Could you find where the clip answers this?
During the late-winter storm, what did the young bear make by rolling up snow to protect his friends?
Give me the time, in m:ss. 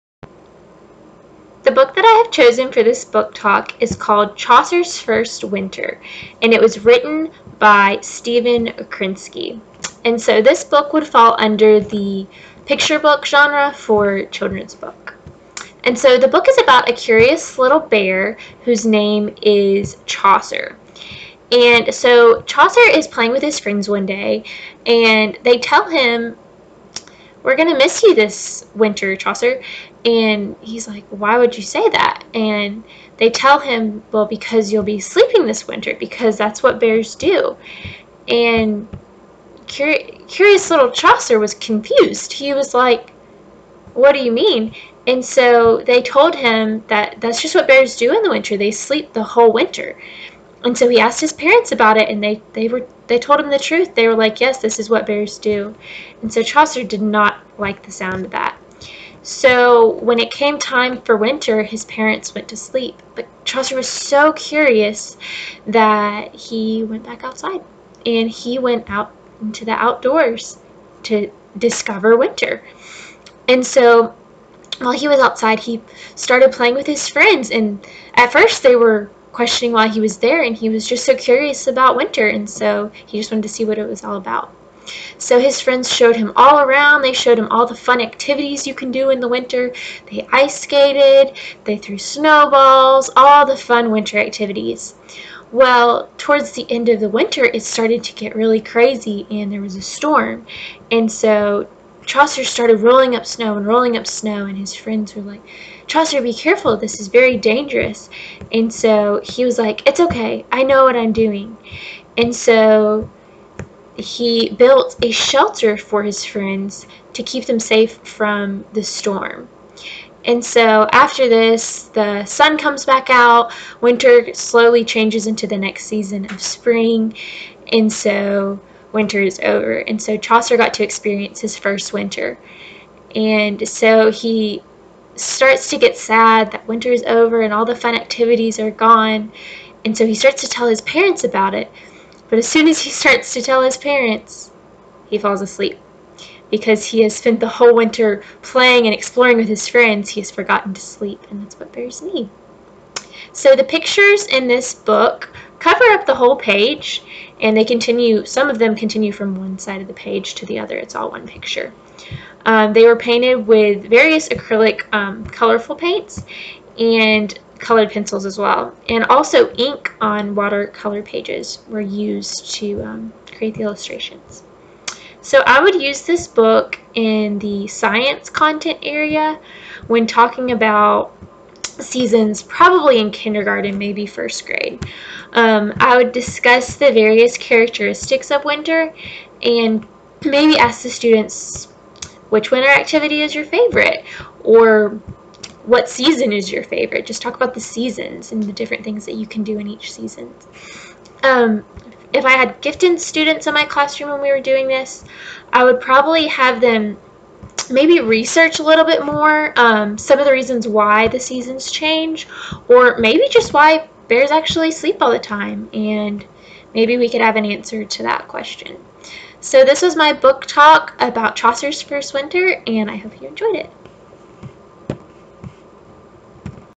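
1:55.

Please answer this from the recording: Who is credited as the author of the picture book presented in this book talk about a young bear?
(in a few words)
Stephen Krensky.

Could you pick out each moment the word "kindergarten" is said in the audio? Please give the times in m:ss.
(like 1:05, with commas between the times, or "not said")
3:03.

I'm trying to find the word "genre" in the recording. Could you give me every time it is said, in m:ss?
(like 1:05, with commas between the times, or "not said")
0:13.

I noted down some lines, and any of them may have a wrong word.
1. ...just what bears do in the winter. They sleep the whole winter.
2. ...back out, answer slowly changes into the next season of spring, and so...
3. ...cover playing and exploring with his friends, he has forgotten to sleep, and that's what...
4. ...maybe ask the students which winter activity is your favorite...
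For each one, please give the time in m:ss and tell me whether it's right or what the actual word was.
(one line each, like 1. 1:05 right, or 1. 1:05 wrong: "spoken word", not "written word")
1. 0:47 right
2. 2:02 wrong: "winter", not "answer"
3. 2:27 wrong: "winter", not "cover"
4. 3:10 right.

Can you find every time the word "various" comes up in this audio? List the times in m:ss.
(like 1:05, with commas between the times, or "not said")
2:43, 3:06.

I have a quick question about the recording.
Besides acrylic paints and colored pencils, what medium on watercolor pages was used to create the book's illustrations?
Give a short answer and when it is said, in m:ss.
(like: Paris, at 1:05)
ink, at 2:49.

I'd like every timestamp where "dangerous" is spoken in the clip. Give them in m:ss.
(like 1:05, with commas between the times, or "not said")
1:47.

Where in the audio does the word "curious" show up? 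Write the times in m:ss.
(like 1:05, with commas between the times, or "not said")
0:16, 0:40, 1:04, 1:21.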